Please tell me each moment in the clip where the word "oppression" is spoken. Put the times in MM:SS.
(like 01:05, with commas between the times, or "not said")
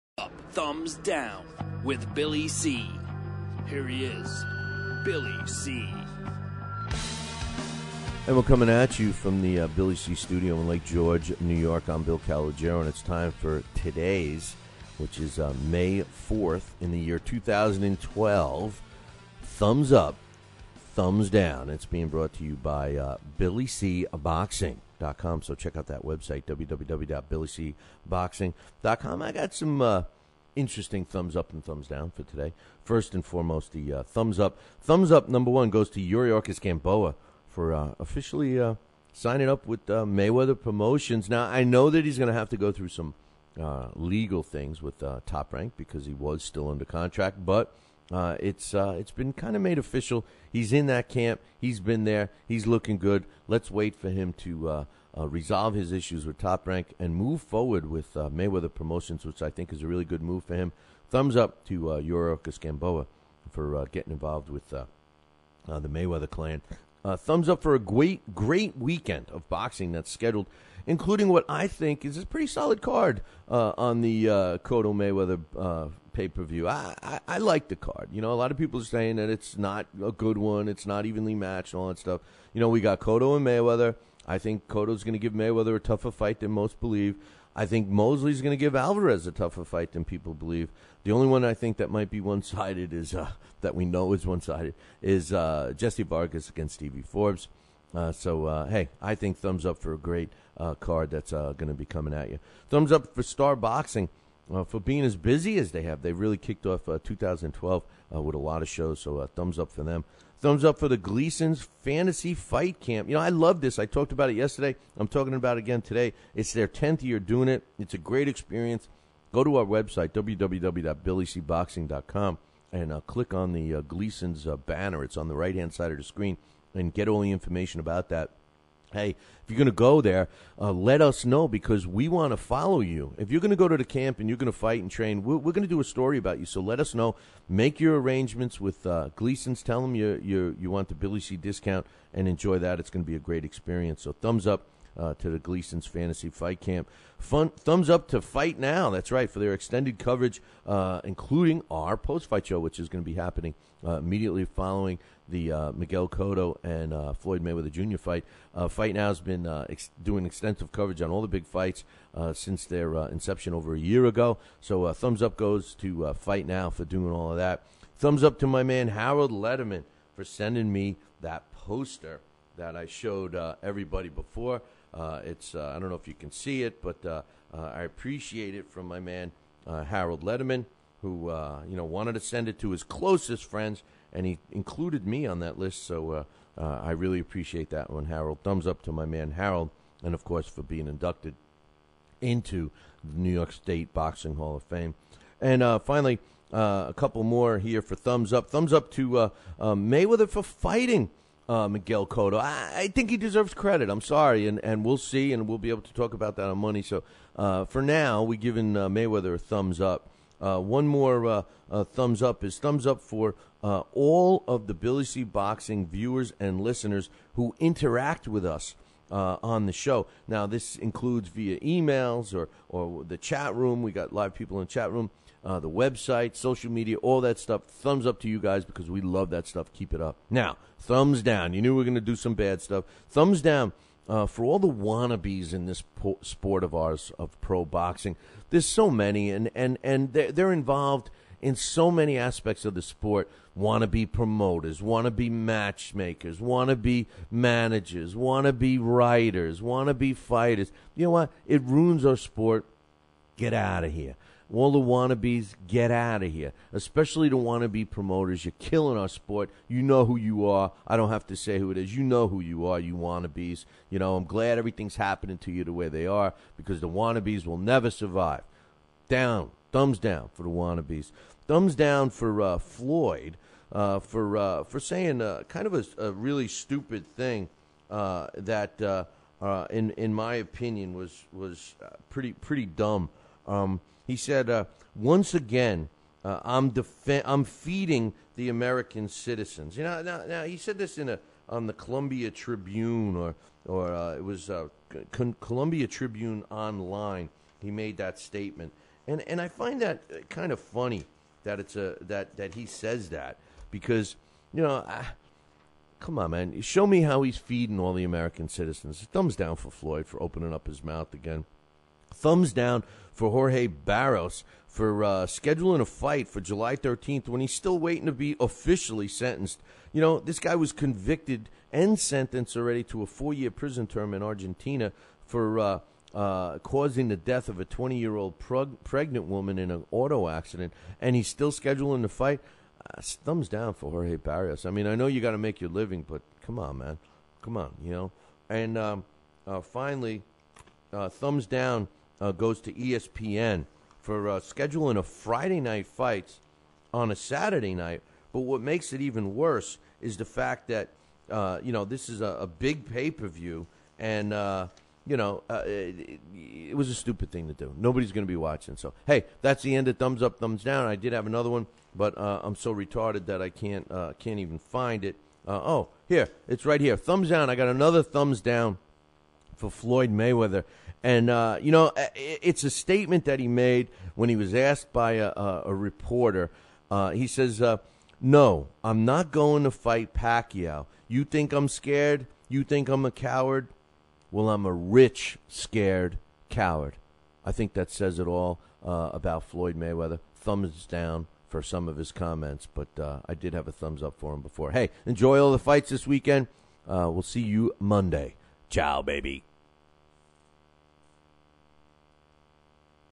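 not said.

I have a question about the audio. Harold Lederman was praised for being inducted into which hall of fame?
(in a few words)
New York State Boxing Hall of Fame.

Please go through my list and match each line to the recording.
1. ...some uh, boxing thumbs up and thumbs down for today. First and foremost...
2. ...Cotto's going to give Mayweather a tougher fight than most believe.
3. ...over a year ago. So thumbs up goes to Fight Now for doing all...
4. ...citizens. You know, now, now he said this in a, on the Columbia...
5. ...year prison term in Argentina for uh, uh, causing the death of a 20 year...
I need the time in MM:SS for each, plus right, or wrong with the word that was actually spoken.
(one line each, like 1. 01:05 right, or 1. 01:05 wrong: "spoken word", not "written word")
1. 00:29 wrong: "interesting", not "boxing"
2. 01:24 right
3. 02:43 right
4. 04:49 right
5. 05:23 right.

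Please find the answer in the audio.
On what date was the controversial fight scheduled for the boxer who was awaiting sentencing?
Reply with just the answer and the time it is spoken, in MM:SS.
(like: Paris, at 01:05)
July 13, at 05:16.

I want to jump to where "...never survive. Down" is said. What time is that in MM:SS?
04:27.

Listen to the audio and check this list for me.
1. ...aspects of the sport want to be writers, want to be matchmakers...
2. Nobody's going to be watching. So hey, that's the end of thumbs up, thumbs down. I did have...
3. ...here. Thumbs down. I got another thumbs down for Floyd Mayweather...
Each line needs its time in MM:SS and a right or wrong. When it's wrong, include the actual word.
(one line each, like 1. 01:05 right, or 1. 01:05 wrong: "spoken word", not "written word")
1. 04:02 wrong: "promoters", not "writers"
2. 05:57 right
3. 06:06 right.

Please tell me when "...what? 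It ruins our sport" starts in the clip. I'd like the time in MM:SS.
04:11.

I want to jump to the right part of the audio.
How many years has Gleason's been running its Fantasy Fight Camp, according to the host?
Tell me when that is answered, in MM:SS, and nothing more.
01:56.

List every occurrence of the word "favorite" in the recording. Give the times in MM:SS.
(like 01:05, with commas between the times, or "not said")
not said.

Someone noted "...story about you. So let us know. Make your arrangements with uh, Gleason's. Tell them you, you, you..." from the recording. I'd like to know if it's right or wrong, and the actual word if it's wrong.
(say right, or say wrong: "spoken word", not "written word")
right.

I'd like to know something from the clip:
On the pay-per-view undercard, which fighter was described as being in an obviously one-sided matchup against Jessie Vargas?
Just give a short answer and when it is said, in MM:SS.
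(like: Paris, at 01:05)
Stevie Forbes, at 01:36.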